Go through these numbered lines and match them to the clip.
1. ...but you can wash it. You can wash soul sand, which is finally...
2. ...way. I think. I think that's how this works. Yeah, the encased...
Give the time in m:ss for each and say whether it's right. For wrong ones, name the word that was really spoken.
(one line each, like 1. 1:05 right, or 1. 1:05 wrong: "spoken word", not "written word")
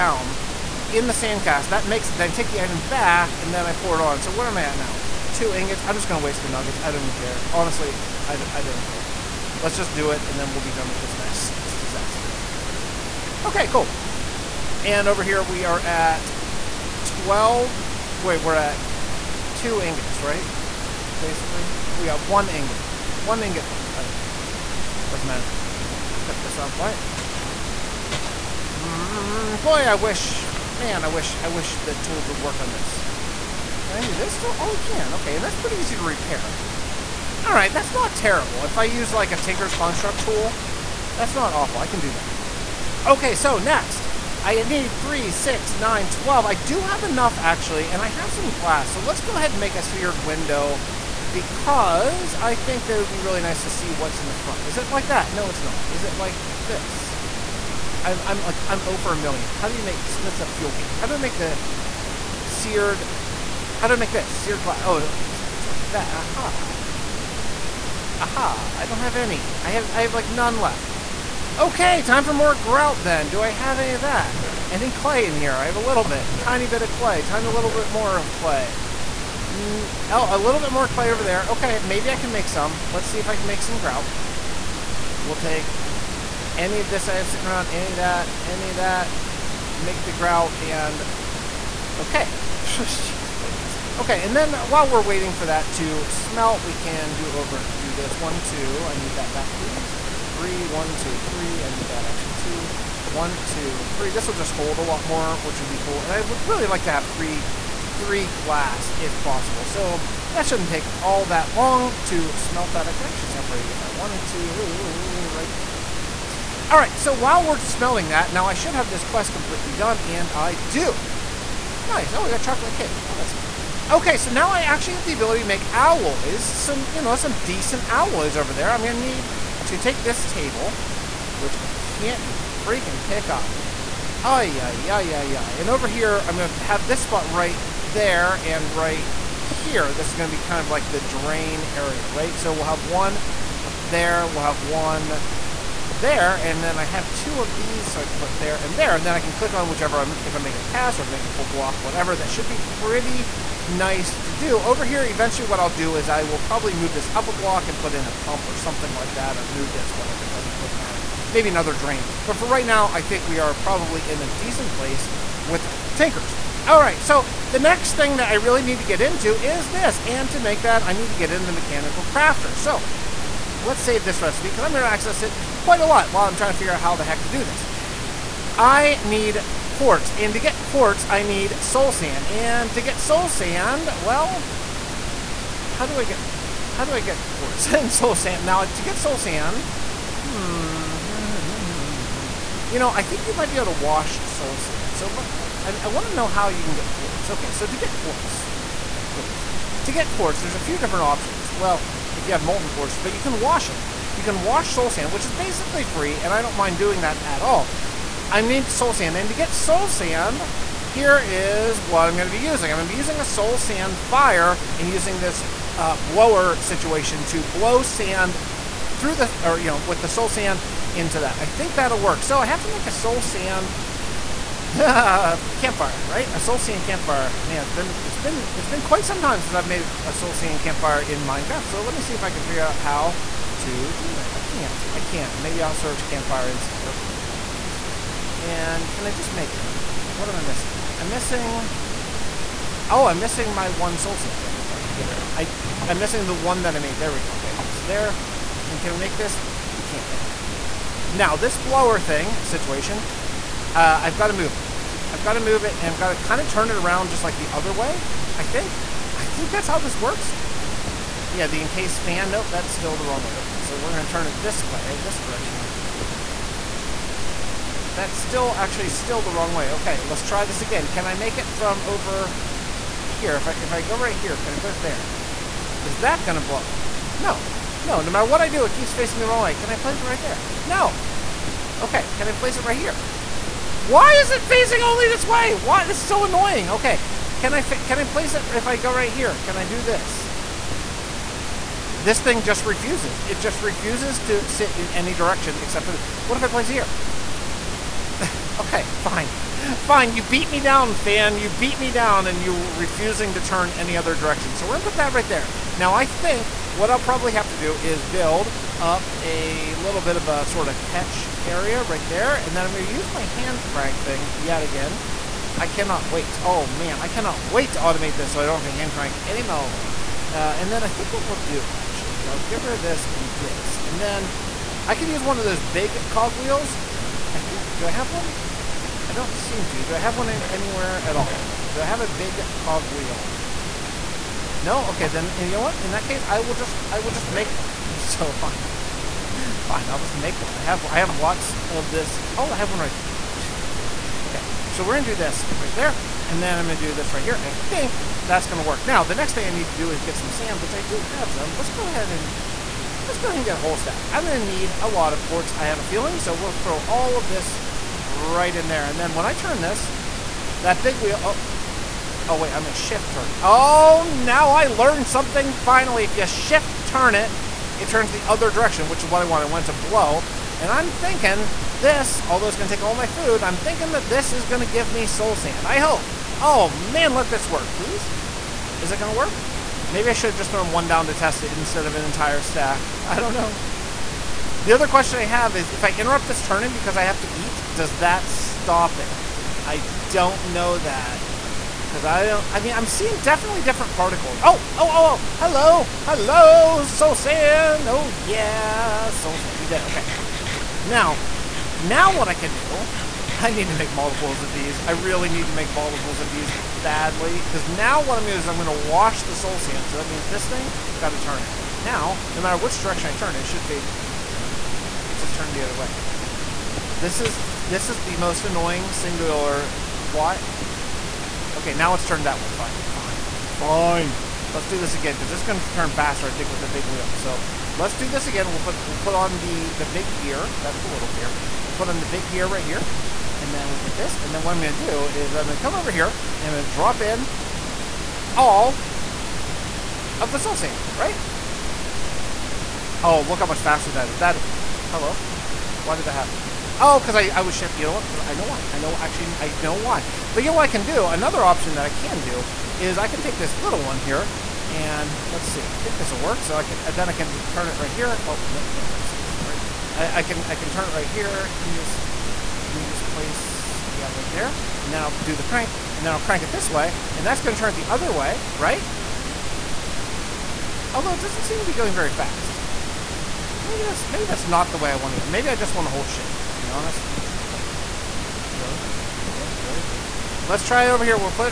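1. 3:22 wrong: "basically", not "finally"
2. 4:17 right.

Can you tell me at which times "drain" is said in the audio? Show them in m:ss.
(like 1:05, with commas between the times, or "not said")
2:21, 2:41.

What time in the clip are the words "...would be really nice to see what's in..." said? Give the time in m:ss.
0:52.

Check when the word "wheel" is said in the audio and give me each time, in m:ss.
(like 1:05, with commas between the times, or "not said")
5:26, 5:32, 6:00, 7:06.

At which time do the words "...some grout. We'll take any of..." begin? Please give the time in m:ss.
1:23.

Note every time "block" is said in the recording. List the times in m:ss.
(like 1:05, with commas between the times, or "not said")
2:31, 2:37.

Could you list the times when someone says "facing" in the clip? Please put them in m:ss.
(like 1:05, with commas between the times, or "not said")
4:38, 4:44.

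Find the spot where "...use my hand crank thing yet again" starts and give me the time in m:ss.
5:12.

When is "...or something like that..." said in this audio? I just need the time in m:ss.
2:38.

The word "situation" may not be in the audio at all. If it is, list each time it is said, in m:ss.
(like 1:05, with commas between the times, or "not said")
3:36, 4:12.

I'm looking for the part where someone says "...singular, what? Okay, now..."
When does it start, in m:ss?
6:58.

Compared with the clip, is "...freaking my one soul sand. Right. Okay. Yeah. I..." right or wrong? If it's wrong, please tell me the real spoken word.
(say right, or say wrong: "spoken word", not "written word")
wrong: "missing", not "freaking".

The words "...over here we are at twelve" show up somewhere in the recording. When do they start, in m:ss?
0:15.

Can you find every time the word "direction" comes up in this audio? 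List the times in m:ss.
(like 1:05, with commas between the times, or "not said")
4:25, 4:55, 5:04, 6:08, 6:52.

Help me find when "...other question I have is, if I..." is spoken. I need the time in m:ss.
6:24.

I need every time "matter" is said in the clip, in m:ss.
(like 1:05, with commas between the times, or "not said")
0:25, 2:40, 4:38, 6:52.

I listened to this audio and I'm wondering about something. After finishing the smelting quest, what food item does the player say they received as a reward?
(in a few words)
chocolate cake.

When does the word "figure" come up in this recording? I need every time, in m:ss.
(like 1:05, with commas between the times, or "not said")
2:56, 3:52.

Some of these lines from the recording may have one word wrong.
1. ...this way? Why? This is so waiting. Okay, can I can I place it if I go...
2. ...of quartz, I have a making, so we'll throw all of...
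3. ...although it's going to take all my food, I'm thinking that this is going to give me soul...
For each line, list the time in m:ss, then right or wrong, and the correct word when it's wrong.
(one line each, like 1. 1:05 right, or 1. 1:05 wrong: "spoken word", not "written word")
1. 4:45 wrong: "annoying", not "waiting"
2. 5:55 wrong: "feeling", not "making"
3. 6:12 right.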